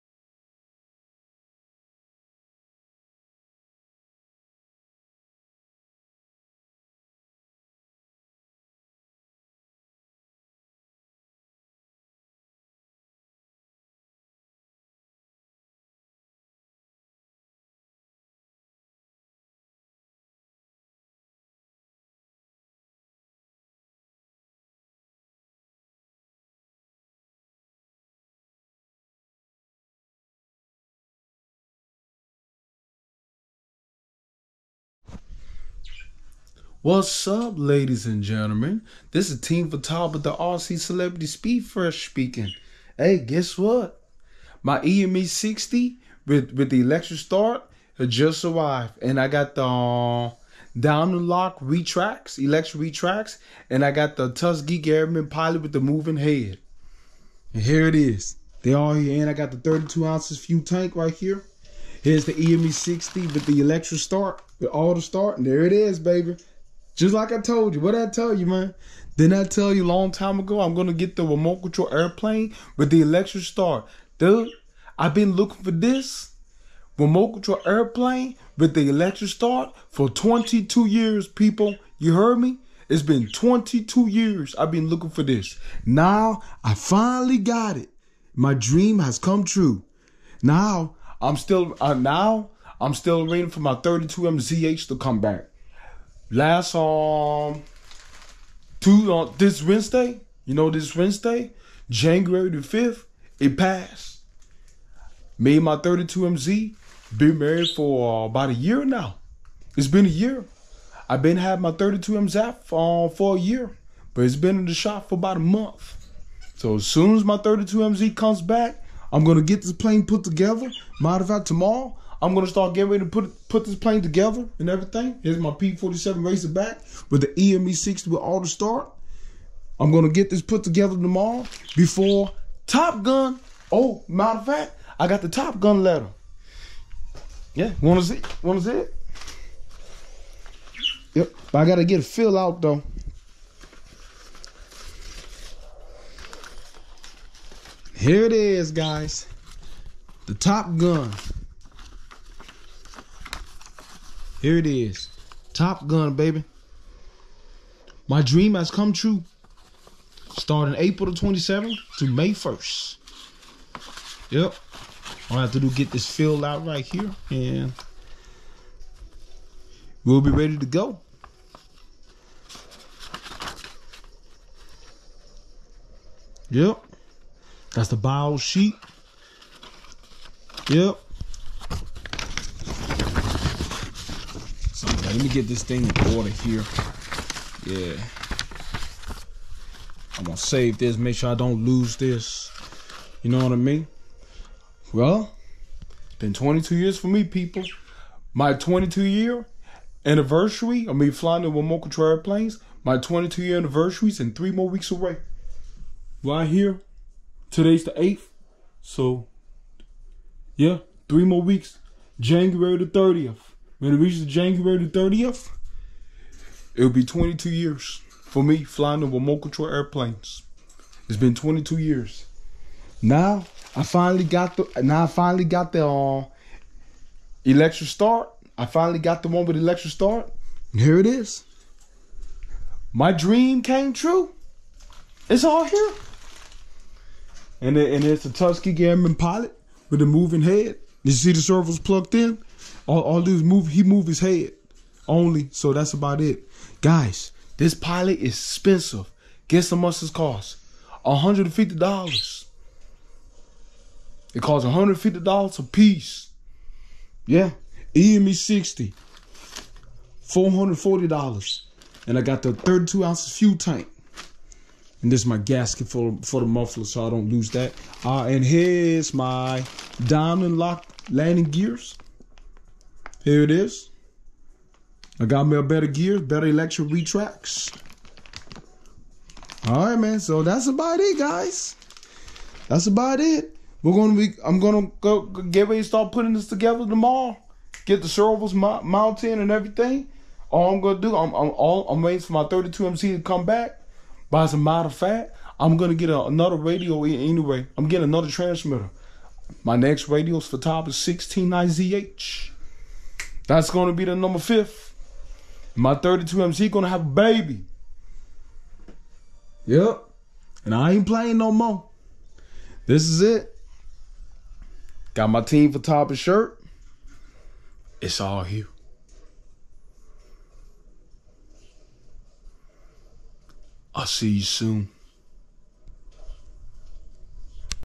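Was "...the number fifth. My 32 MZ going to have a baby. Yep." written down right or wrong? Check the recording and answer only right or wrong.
right.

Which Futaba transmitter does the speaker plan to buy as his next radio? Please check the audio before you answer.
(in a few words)
16IZH.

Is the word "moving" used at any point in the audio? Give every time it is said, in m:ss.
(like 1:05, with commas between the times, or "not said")
0:55, 4:00.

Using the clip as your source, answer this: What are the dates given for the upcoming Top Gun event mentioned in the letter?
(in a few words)
April 27th to May 1st.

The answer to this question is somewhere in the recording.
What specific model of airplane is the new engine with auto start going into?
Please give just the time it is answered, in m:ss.
2:05.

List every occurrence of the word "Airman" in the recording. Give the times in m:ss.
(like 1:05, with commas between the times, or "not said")
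0:54, 3:58.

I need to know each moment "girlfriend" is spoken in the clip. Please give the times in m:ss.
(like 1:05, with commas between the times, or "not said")
not said.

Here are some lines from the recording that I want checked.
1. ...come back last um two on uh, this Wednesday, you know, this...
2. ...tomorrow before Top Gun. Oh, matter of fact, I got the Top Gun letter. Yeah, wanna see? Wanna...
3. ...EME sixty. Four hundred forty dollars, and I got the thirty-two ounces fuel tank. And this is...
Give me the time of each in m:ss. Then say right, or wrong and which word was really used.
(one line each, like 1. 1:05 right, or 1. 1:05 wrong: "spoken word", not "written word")
1. 1:34 right
2. 2:10 right
3. 4:17 right.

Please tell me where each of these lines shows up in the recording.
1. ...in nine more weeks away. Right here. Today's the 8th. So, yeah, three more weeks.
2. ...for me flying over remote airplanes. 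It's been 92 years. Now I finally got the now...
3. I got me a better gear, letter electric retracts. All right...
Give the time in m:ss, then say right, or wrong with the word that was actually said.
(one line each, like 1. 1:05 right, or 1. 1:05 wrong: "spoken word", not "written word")
1. 3:24 wrong: "three", not "nine"
2. 3:38 wrong: "22", not "92"
3. 4:35 wrong: "better", not "letter".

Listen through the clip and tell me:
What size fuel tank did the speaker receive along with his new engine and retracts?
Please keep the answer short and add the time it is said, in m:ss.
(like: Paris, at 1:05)
32 ounces, at 0:59.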